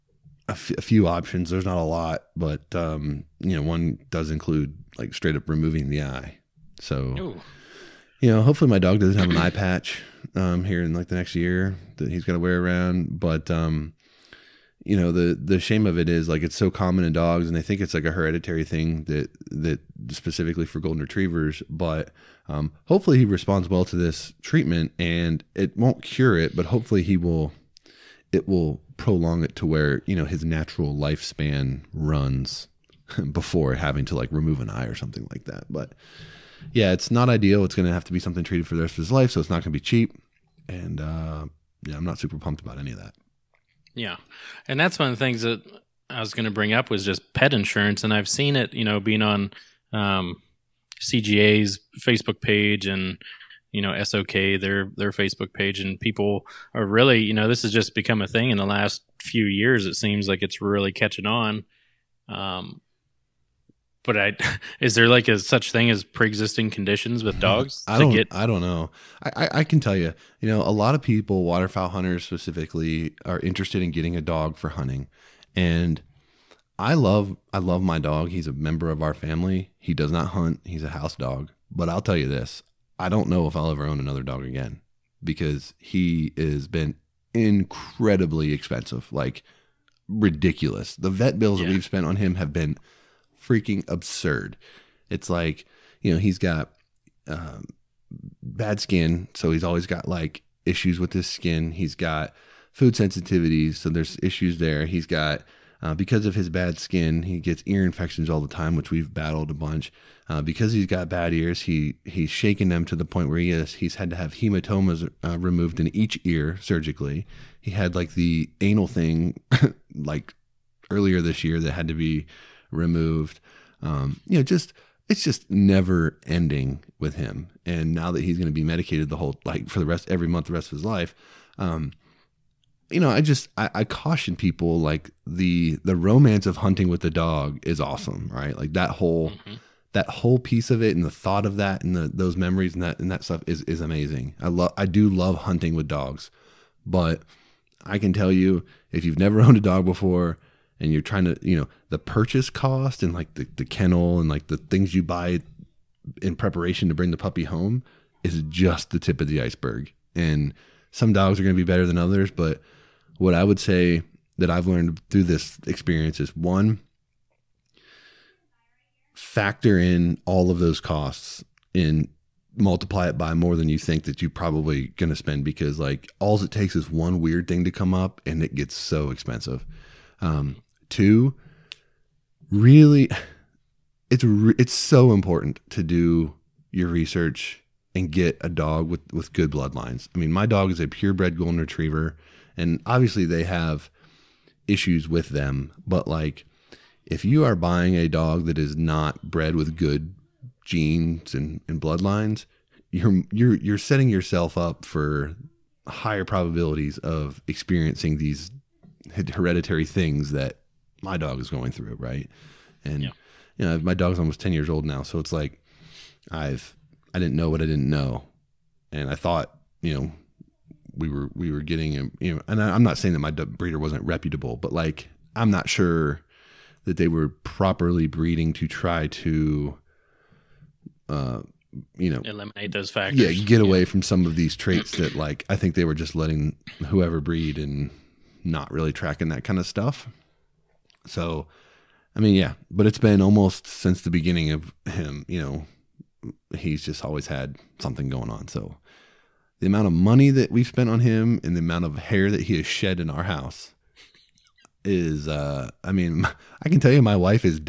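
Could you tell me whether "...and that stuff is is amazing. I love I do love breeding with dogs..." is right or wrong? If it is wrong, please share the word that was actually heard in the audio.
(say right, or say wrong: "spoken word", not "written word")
wrong: "hunting", not "breeding".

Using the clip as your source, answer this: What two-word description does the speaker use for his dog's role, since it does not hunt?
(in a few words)
house dog.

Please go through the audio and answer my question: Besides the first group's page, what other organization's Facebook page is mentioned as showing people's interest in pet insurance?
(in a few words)
SOK.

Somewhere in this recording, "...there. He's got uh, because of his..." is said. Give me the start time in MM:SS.
01:44.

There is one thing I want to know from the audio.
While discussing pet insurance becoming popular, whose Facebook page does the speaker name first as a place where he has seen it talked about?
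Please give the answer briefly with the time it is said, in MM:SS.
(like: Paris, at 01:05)
CGA, at 00:50.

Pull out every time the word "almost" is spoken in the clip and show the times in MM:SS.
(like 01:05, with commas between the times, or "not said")
03:34, 04:03.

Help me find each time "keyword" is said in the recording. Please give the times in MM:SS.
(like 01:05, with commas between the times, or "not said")
not said.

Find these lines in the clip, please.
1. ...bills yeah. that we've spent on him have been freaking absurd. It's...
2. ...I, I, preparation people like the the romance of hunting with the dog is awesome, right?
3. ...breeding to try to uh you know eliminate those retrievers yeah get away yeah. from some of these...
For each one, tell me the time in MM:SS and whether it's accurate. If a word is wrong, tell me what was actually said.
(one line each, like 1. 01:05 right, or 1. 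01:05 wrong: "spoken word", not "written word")
1. 01:31 right
2. 02:13 wrong: "caution", not "preparation"
3. 03:48 wrong: "factors", not "retrievers".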